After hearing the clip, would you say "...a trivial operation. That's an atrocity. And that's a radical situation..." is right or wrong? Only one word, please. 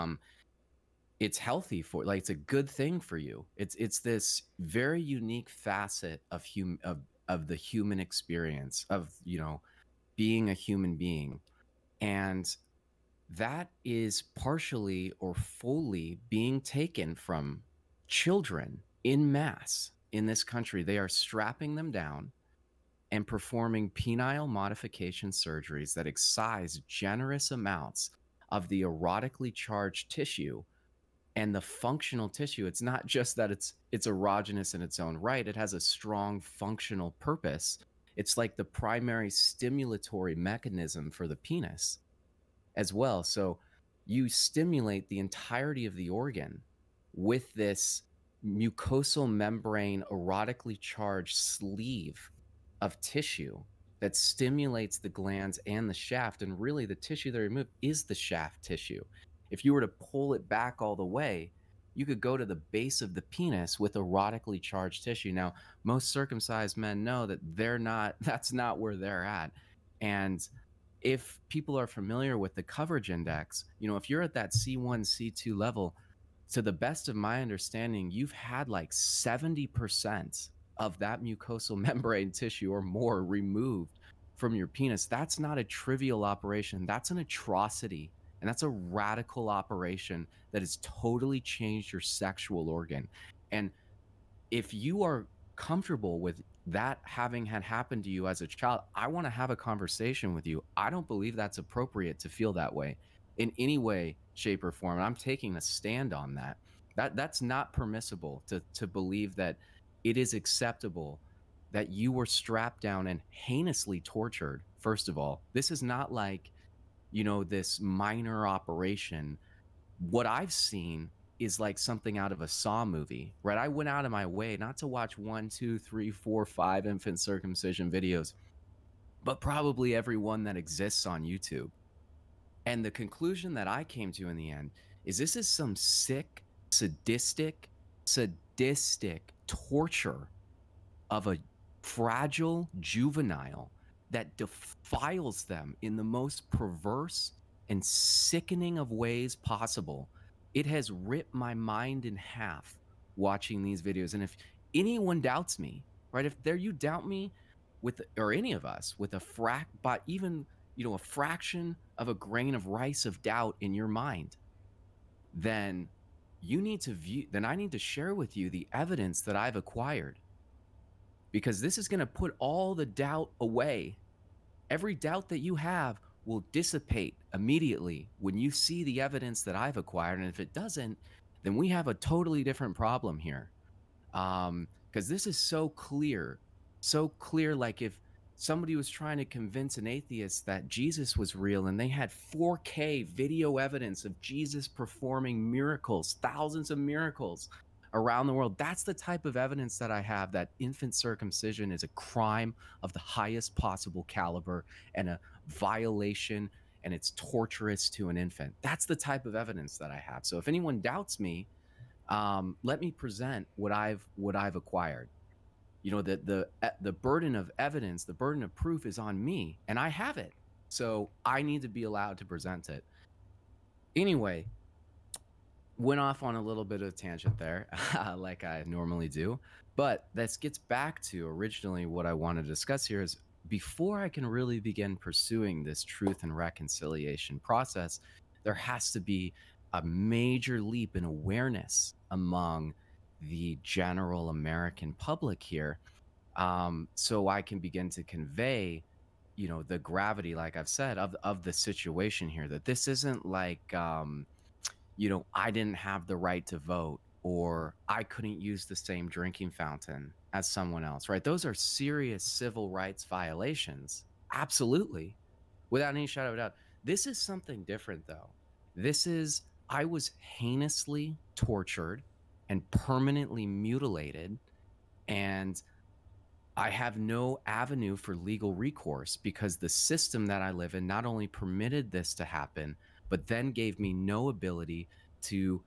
wrong.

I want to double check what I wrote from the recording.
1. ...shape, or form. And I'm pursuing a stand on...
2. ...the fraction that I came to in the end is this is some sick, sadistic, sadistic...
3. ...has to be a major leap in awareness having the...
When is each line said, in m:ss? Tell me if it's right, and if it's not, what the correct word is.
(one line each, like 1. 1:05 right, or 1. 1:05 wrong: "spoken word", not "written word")
1. 1:44 wrong: "taking", not "pursuing"
2. 2:12 wrong: "conclusion", not "fraction"
3. 3:58 wrong: "among", not "having".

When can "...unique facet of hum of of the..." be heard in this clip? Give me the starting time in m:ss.
0:05.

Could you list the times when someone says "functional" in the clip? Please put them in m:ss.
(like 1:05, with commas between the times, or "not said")
0:31, 0:36.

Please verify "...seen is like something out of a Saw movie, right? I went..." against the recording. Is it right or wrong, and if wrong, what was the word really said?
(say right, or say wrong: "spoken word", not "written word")
right.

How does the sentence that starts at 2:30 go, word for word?
It has ripped my mind in half watching these videos.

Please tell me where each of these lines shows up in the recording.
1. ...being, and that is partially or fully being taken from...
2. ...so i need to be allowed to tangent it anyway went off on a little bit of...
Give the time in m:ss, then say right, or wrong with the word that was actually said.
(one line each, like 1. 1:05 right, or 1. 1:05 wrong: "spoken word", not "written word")
1. 0:10 right
2. 3:40 wrong: "present", not "tangent".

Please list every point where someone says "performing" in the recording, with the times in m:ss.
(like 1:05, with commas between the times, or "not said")
0:23, 3:14.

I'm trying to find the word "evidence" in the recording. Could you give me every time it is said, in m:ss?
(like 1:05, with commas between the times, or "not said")
2:48, 2:58, 3:13, 3:19, 3:29, 3:37.